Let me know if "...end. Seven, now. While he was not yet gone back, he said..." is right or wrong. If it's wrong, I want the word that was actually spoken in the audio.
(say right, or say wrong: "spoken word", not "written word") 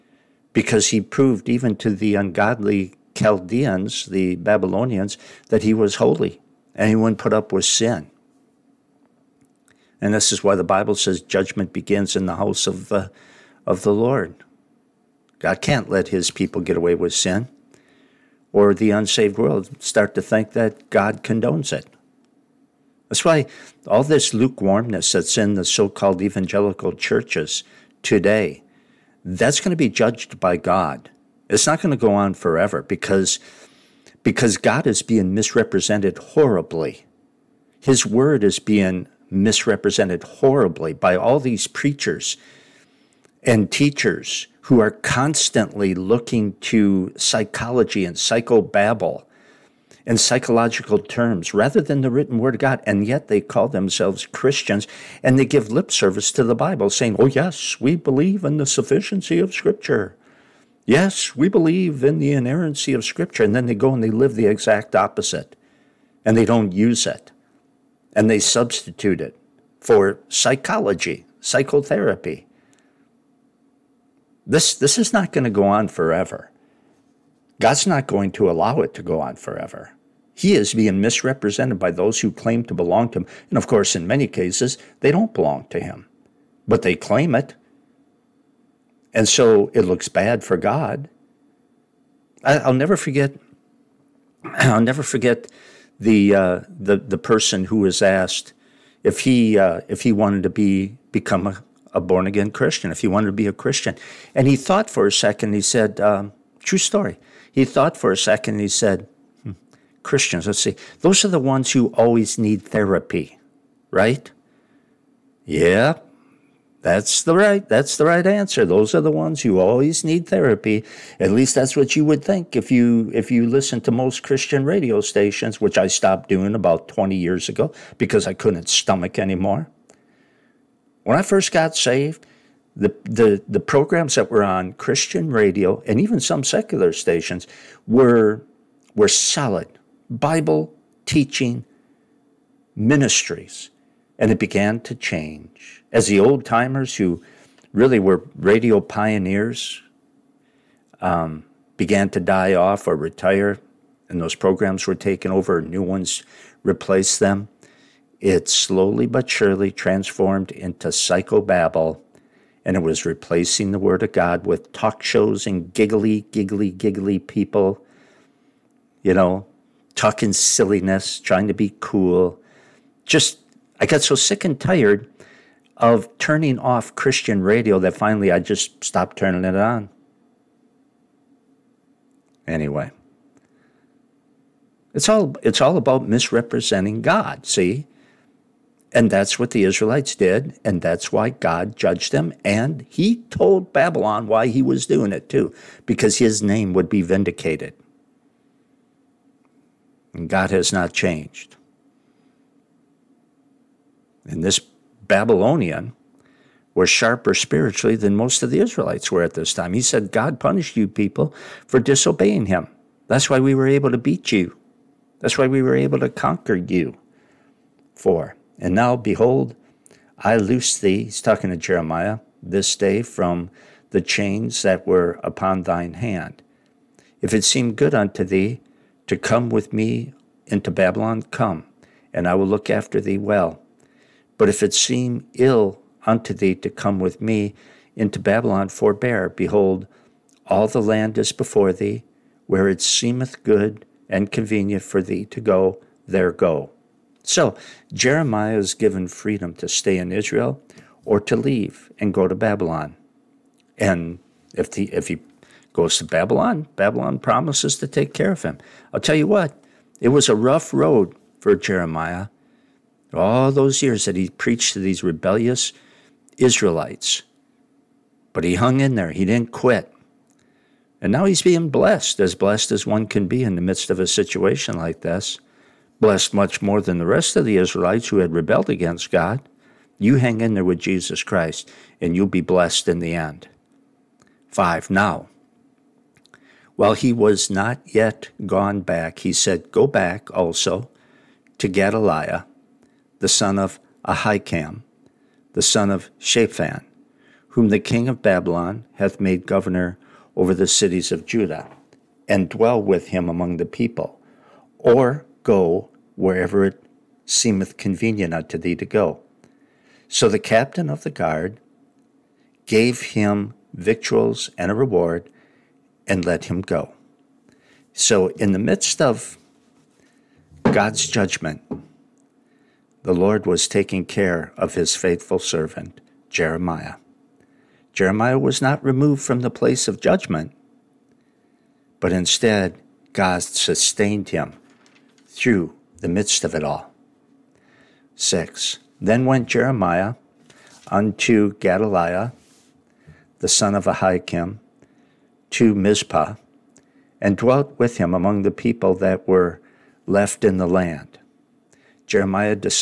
wrong: "Five", not "Seven".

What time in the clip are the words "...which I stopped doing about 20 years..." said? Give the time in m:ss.
2:05.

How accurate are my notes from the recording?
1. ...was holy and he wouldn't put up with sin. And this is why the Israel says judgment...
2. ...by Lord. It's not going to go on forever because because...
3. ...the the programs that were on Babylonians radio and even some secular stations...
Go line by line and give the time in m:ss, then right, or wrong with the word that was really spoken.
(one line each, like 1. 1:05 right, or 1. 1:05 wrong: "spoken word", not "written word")
1. 0:05 wrong: "Bible", not "Israel"
2. 0:30 wrong: "God", not "Lord"
3. 2:13 wrong: "Christian", not "Babylonians".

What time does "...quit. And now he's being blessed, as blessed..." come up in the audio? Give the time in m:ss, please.
4:29.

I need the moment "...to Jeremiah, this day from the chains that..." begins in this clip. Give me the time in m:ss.
3:41.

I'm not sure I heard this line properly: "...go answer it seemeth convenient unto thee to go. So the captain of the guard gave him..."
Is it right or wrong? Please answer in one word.
wrong.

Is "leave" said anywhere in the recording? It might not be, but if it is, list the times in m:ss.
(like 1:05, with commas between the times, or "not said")
4:11.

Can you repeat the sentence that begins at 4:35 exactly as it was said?
Blessed much more than the rest of the Israelites who had rebelled against God.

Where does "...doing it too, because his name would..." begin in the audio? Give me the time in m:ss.
3:14.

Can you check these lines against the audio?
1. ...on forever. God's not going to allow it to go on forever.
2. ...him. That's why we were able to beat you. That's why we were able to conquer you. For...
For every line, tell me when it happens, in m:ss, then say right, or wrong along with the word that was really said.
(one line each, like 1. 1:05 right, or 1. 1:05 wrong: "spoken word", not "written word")
1. 1:15 right
2. 3:32 right.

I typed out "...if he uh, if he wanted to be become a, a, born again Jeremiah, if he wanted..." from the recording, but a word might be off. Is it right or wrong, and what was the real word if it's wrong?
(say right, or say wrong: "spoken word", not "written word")
wrong: "Christian", not "Jeremiah".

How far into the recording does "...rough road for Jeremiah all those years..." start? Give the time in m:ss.
4:20.